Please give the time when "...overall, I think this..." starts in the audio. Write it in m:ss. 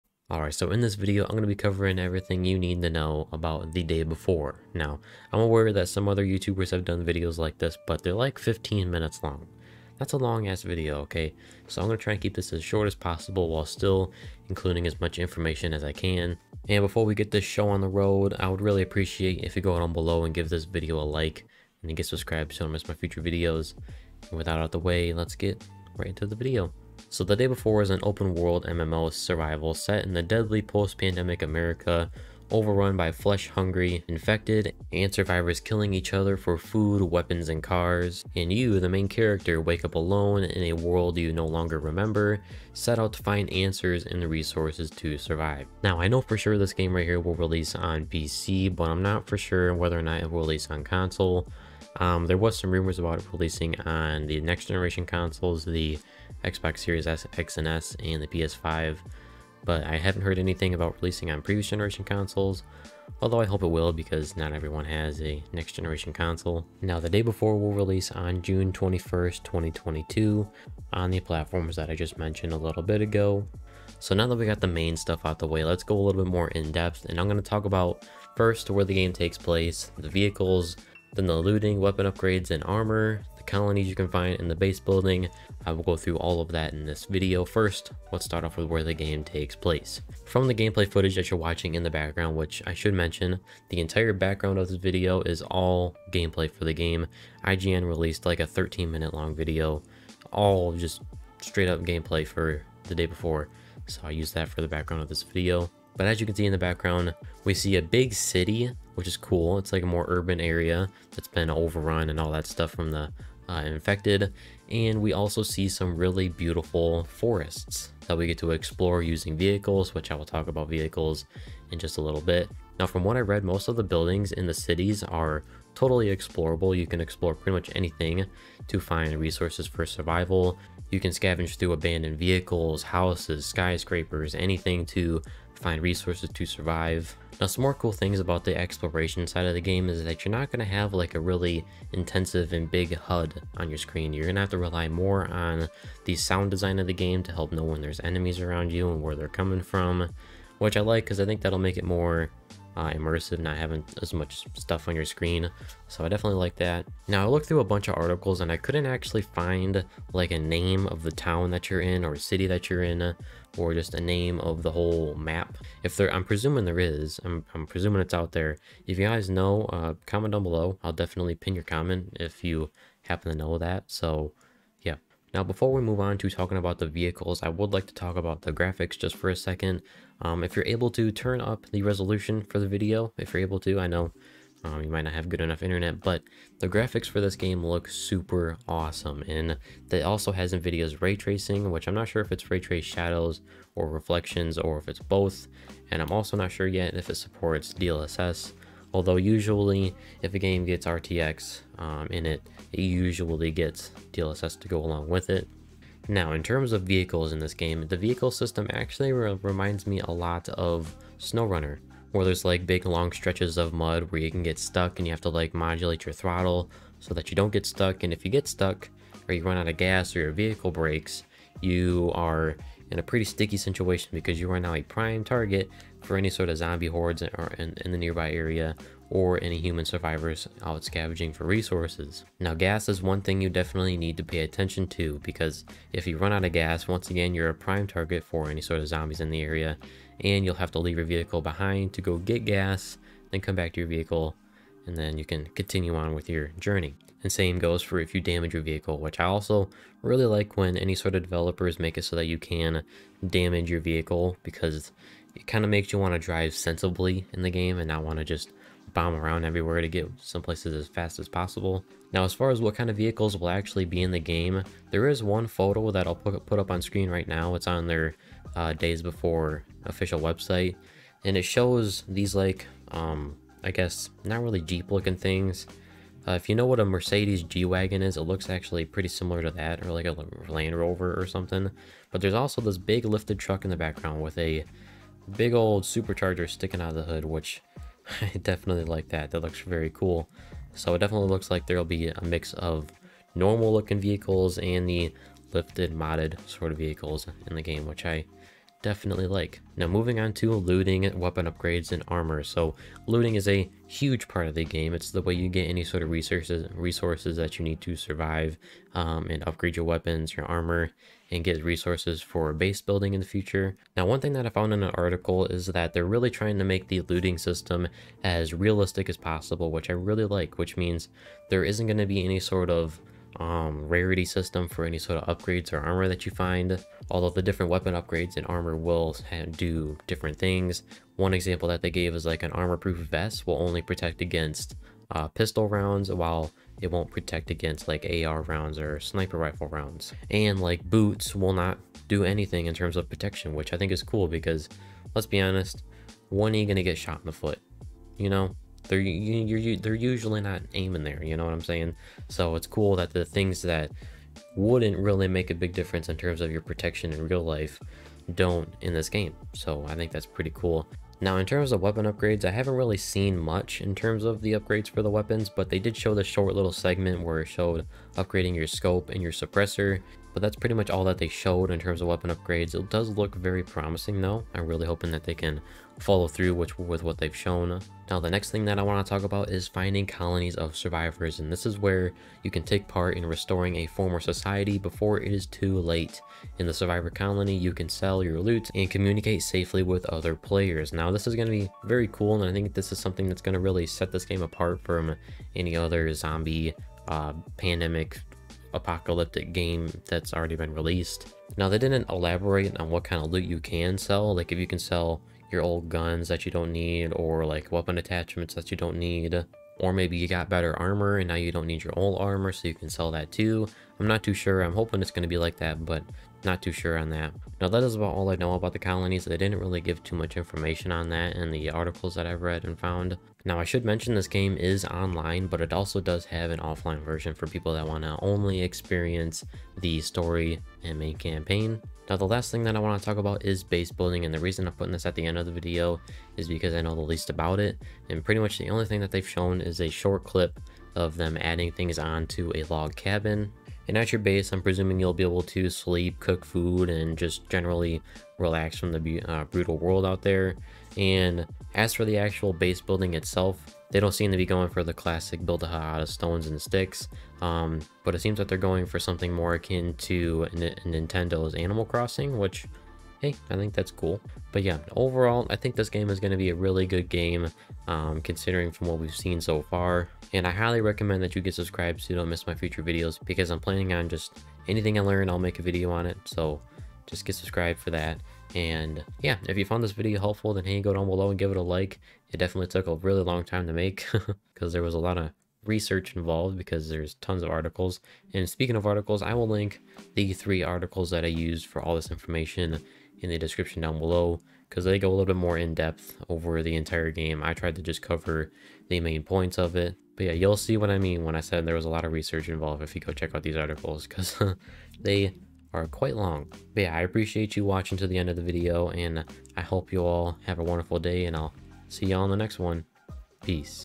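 7:44.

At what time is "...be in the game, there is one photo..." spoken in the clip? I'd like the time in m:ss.
4:23.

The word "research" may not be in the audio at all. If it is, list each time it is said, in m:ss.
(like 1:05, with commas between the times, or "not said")
8:05, 8:22.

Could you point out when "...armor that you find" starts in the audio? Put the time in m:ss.
5:25.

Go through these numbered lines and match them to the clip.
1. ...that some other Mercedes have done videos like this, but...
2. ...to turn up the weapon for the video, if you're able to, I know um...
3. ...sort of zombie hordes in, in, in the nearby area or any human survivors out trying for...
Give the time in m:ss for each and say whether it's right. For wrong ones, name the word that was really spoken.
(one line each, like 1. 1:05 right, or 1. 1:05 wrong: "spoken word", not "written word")
1. 0:05 wrong: "YouTubers", not "Mercedes"
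2. 3:00 wrong: "resolution", not "weapon"
3. 3:46 wrong: "scavenging", not "trying".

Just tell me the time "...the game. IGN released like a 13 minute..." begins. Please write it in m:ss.
1:36.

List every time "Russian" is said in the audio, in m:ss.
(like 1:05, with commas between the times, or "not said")
not said.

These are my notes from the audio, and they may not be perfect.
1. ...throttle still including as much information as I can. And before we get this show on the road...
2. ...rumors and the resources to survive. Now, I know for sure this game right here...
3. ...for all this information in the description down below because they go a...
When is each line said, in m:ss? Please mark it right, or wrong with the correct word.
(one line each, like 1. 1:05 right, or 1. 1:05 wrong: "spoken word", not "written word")
1. 0:13 wrong: "while", not "throttle"
2. 0:43 wrong: "answers", not "rumors"
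3. 8:11 right.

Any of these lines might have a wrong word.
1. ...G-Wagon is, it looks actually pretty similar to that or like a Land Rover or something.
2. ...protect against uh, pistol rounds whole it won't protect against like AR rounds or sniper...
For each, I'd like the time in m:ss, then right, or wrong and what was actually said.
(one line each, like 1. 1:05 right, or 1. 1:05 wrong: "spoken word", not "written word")
1. 4:37 right
2. 5:33 wrong: "while", not "whole".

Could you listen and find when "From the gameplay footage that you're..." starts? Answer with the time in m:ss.
1:30.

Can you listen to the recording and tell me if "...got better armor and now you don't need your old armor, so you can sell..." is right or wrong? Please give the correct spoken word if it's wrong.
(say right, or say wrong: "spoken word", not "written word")
right.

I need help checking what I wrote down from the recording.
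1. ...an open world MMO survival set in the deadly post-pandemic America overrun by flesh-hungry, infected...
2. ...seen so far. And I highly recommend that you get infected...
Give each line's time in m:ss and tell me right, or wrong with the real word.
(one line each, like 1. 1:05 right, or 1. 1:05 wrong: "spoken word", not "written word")
1. 0:27 right
2. 7:49 wrong: "subscribed", not "infected".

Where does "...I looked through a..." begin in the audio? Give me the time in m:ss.
2:37.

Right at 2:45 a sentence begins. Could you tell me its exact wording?
If there, I'm presuming there is, I'm, I'm presuming it's out there.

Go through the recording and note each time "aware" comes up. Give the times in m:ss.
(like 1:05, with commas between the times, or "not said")
0:05.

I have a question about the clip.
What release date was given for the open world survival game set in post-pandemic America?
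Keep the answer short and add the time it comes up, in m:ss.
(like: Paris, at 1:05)
June 21, 2022, at 1:08.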